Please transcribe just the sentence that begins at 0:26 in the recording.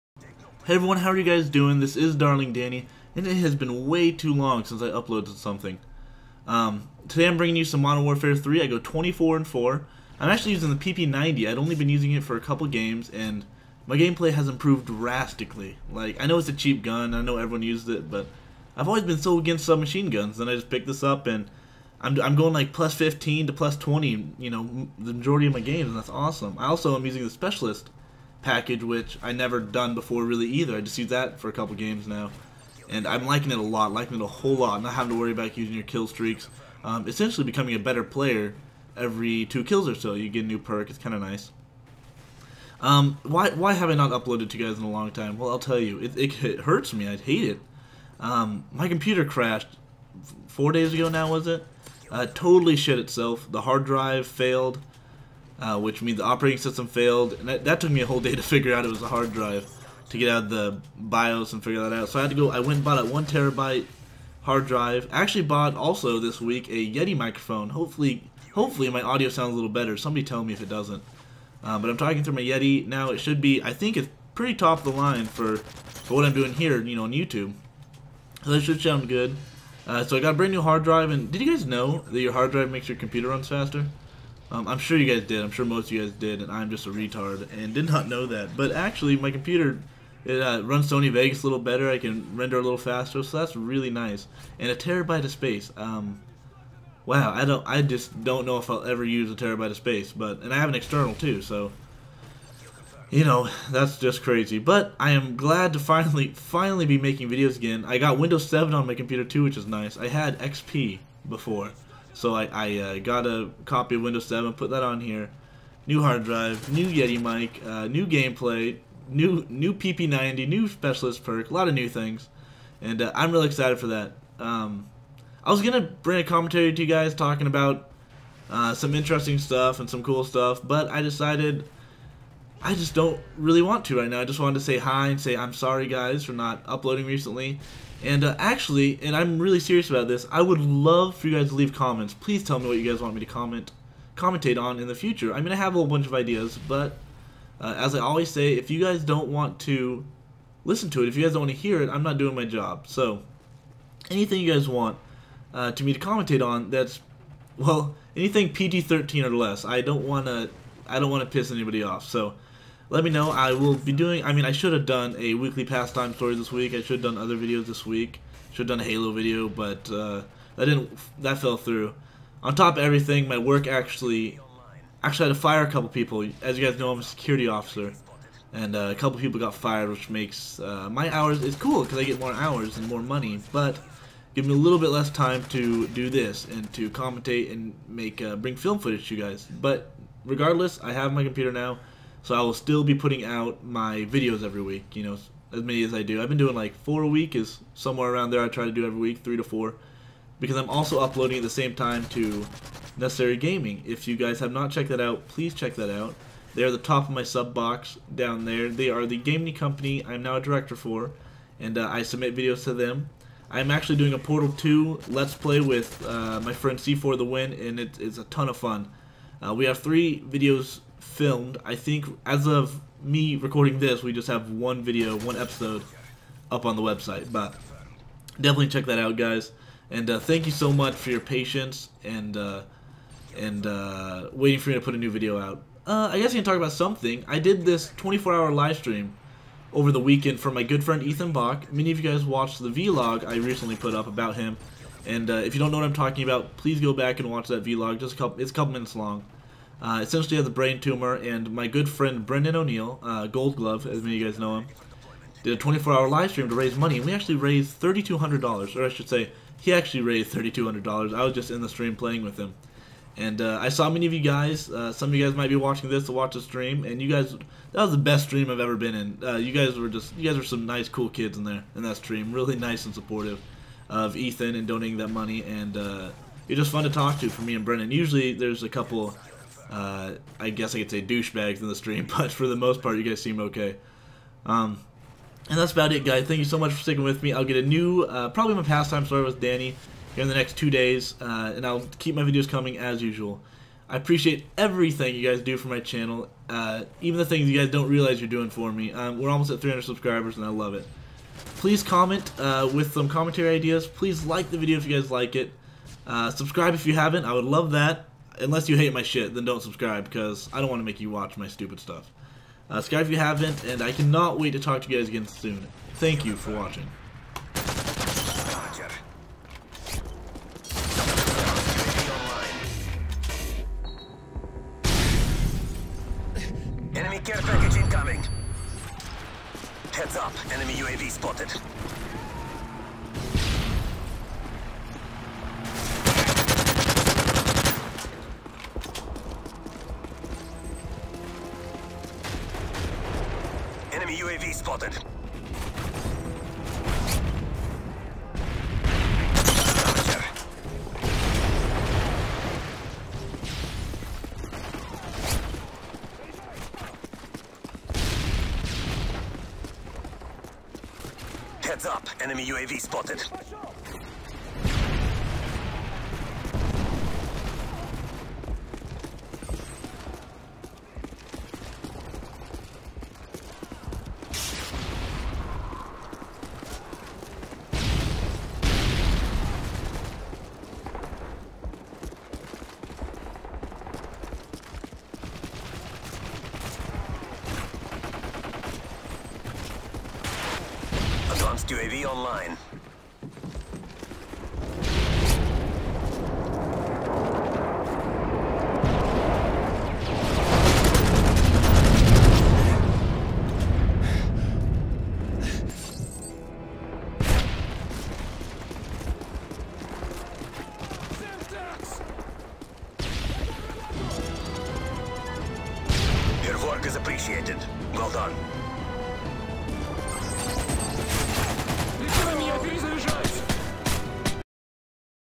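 I also am using the Specialist, package, which I never done before really either.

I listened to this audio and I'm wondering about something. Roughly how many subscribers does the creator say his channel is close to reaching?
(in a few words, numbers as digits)
300.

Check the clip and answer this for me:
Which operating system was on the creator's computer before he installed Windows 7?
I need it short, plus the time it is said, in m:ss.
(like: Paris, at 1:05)
XP, at 1:50.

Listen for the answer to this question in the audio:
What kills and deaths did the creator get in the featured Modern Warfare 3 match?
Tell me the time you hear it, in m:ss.
0:08.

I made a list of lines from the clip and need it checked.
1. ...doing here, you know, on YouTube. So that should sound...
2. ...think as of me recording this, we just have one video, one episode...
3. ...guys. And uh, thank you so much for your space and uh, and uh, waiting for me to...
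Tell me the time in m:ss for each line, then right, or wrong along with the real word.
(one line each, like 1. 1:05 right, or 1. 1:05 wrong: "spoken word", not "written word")
1. 1:16 right
2. 3:41 right
3. 3:49 wrong: "patience", not "space".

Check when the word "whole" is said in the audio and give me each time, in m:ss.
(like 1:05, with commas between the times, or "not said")
0:34, 0:58, 2:25.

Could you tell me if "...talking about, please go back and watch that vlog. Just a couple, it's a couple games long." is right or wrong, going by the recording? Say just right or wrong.
wrong.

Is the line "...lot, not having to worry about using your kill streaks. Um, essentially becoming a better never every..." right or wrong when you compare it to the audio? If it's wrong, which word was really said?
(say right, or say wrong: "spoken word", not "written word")
wrong: "player", not "never".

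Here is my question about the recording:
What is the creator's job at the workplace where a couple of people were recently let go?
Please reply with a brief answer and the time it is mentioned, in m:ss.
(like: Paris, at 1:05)
Security officer, at 2:57.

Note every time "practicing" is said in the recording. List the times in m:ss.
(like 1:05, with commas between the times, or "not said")
not said.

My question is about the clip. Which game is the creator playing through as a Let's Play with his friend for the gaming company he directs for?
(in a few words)
Portal 2.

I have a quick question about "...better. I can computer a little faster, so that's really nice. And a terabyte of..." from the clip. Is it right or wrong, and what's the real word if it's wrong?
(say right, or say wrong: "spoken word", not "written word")
wrong: "render", not "computer".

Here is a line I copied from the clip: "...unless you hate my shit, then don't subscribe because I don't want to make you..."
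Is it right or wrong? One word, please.
right.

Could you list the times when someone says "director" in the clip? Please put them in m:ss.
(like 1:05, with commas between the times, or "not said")
3:30.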